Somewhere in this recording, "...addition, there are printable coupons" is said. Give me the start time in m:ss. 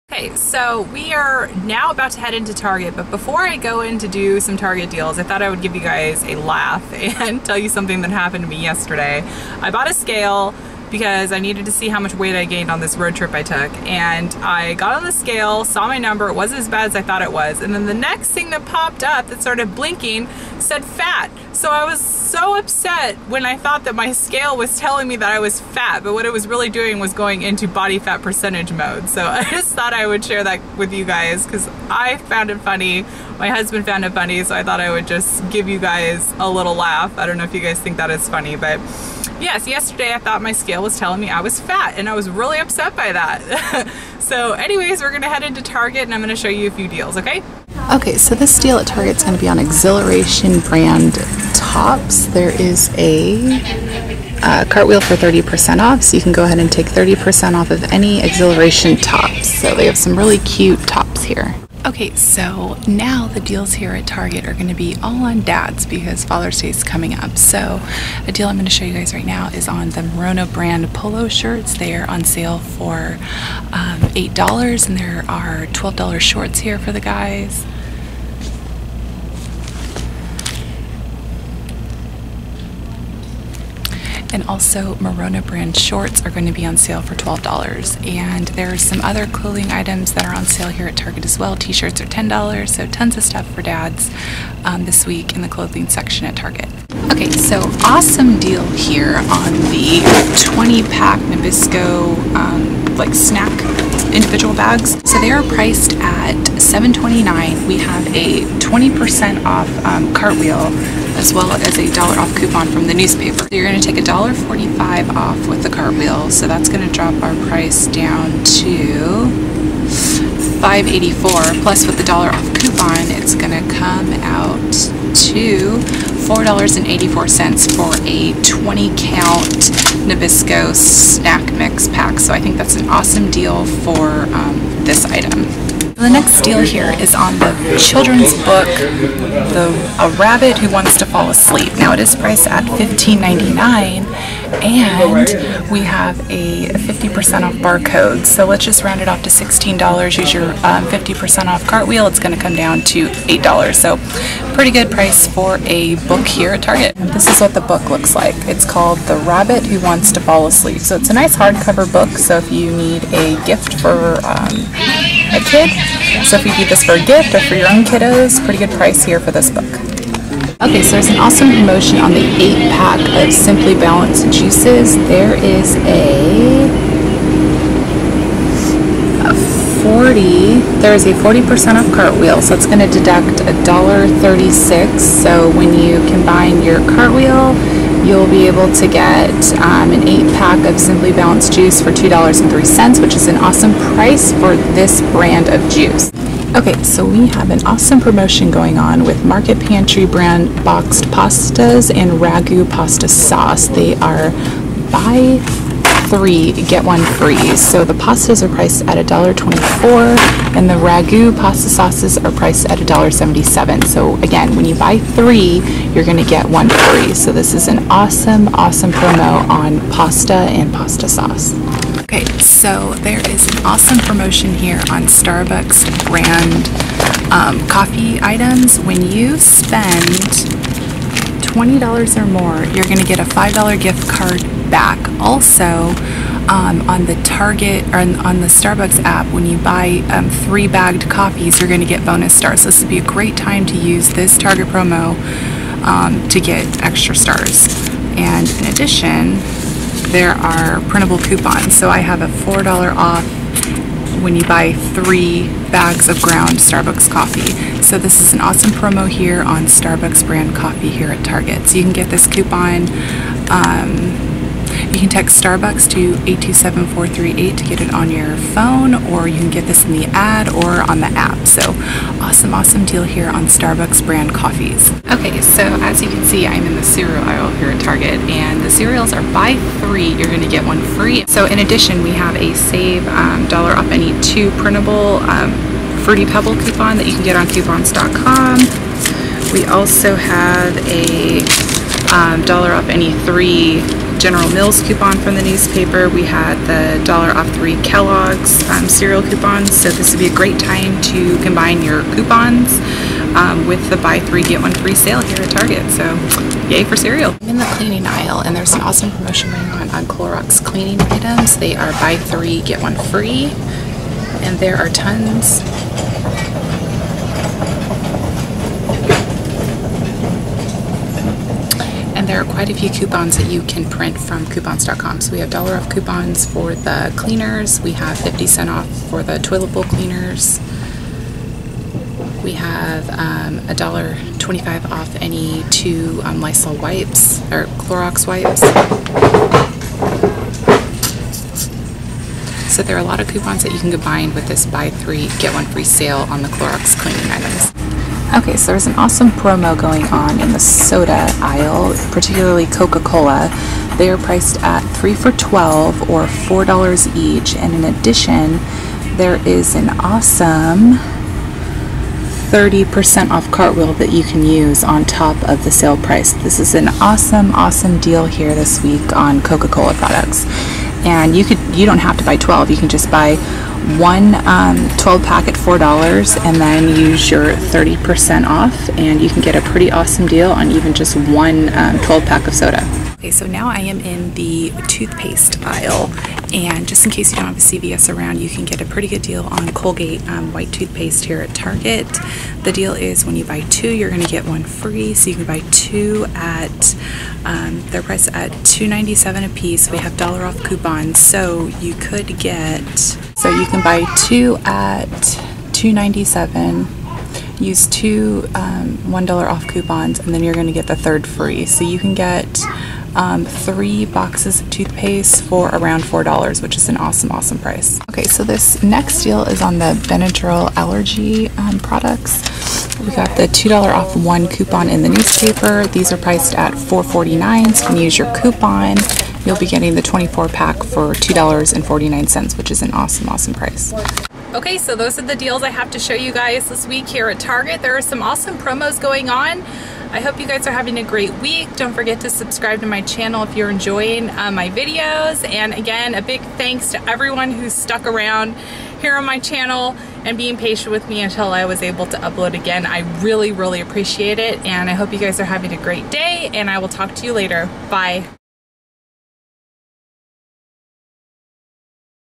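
4:08.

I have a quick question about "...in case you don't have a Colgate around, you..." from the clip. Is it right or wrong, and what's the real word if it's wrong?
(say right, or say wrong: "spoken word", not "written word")
wrong: "CVS", not "Colgate".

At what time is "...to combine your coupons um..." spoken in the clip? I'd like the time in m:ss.
5:01.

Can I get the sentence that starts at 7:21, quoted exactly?
Don't forget to subscribe to my channel if you're enjoying uh, my videos.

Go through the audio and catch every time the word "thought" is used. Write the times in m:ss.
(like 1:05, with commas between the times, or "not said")
0:05, 0:17, 0:23, 0:29, 0:34, 0:40.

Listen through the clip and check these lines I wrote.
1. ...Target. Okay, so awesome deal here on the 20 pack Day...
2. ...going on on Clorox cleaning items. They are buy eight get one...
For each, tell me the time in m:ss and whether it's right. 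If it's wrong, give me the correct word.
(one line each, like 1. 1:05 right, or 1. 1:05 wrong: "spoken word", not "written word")
1. 1:36 wrong: "Nabisco", not "Day"
2. 5:09 wrong: "three", not "eight".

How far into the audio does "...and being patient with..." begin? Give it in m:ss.
7:30.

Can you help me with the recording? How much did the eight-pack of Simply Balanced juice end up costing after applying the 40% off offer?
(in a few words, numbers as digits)
$2.03.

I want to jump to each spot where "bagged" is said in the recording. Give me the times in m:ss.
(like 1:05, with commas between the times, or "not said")
4:00.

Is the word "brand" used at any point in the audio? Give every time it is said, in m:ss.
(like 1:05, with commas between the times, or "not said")
0:50, 1:10, 1:25, 3:15, 3:20, 3:46, 4:20, 4:34.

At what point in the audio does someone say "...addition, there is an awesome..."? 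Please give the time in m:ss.
5:57.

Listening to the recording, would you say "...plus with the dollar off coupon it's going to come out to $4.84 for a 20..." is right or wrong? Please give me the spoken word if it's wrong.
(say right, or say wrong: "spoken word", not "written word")
right.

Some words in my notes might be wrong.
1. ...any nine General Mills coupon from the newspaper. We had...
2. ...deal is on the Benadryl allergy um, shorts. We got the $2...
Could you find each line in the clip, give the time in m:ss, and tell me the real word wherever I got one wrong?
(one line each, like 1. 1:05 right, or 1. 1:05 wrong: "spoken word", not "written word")
1. 4:52 wrong: "three", not "nine"
2. 6:59 wrong: "products", not "shorts".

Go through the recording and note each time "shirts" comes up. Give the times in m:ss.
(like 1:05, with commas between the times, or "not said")
1:11, 1:31.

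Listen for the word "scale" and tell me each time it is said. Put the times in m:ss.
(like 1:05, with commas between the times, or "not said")
0:09, 0:15, 0:24, 0:40.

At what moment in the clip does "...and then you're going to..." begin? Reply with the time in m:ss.
6:50.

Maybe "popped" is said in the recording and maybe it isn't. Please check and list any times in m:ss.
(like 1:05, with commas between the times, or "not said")
0:18.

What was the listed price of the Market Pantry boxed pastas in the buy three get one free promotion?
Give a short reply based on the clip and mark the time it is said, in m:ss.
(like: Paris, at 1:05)
$1.24, at 3:28.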